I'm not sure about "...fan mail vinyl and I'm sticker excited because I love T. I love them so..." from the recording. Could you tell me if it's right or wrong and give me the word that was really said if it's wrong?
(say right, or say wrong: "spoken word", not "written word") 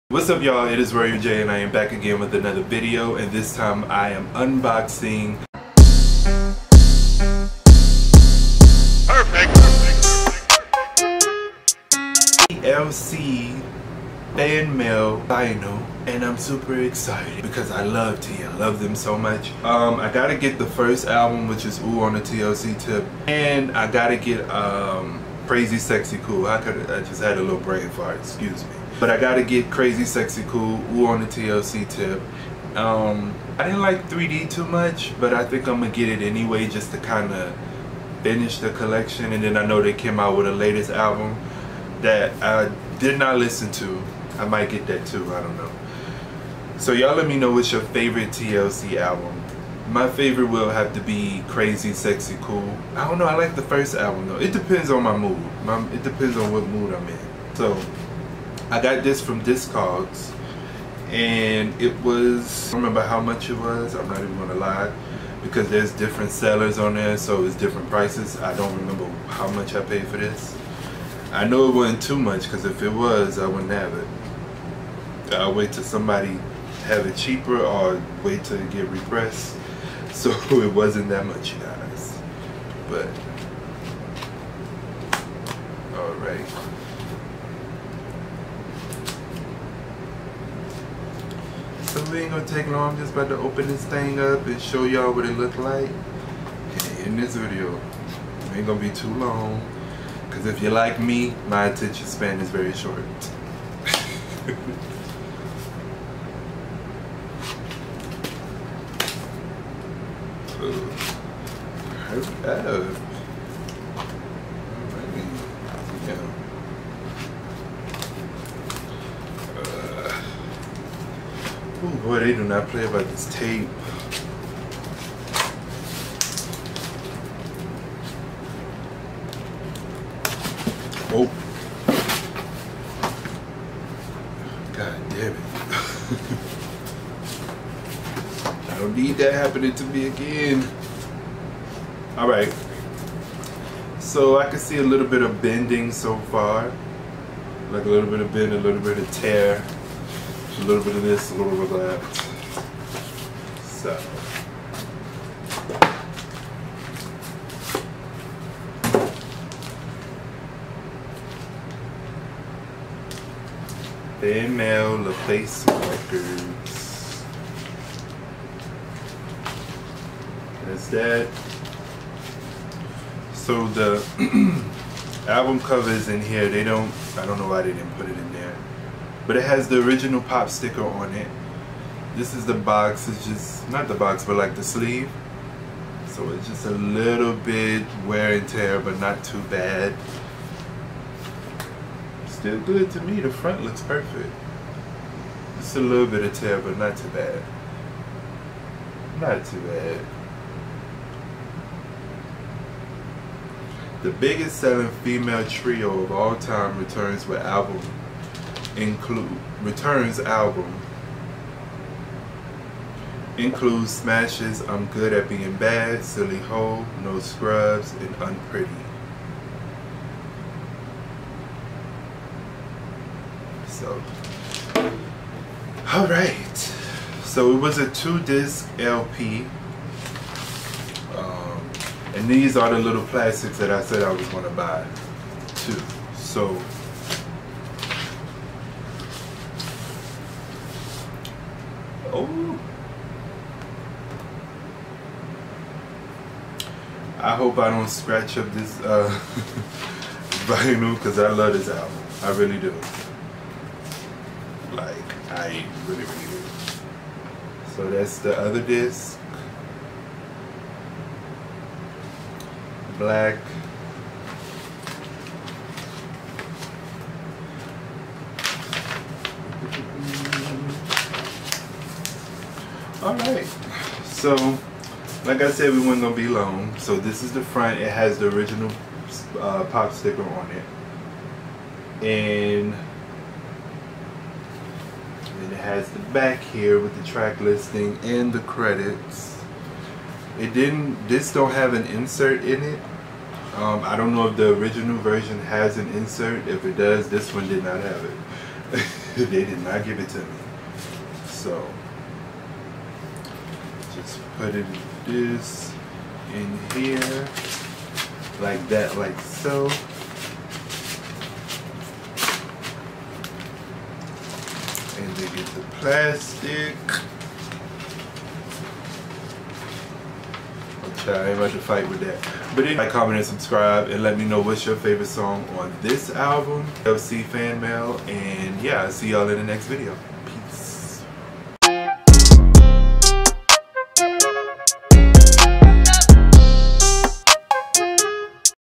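wrong: "super", not "sticker".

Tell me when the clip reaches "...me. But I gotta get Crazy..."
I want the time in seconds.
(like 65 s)
28 s.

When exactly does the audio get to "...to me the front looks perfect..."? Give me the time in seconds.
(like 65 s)
192 s.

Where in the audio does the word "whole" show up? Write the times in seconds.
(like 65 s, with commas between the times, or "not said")
not said.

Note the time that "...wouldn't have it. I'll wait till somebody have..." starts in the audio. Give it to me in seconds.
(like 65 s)
73 s.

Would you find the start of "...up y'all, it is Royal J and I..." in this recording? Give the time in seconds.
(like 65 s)
0 s.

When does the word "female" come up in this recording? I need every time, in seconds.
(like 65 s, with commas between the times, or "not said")
164 s, 205 s.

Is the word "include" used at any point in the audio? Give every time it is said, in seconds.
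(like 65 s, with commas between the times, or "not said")
208 s, 213 s.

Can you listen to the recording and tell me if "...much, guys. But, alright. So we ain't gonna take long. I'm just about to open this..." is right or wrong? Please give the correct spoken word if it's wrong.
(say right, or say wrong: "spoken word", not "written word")
right.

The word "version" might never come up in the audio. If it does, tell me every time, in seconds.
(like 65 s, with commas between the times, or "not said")
294 s.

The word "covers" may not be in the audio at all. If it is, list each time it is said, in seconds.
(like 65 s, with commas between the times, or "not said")
175 s.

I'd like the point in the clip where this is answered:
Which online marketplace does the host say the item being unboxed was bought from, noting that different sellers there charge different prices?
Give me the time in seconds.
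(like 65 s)
59 s.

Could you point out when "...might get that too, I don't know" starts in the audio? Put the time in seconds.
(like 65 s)
44 s.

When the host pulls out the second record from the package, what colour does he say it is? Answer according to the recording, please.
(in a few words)
Black.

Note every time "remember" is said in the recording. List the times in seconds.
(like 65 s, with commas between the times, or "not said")
62 s, 68 s.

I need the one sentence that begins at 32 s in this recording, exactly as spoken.
Um, I didn't like 3D too much, but I think I'm gonna get it anyway just to kind of finish the collection.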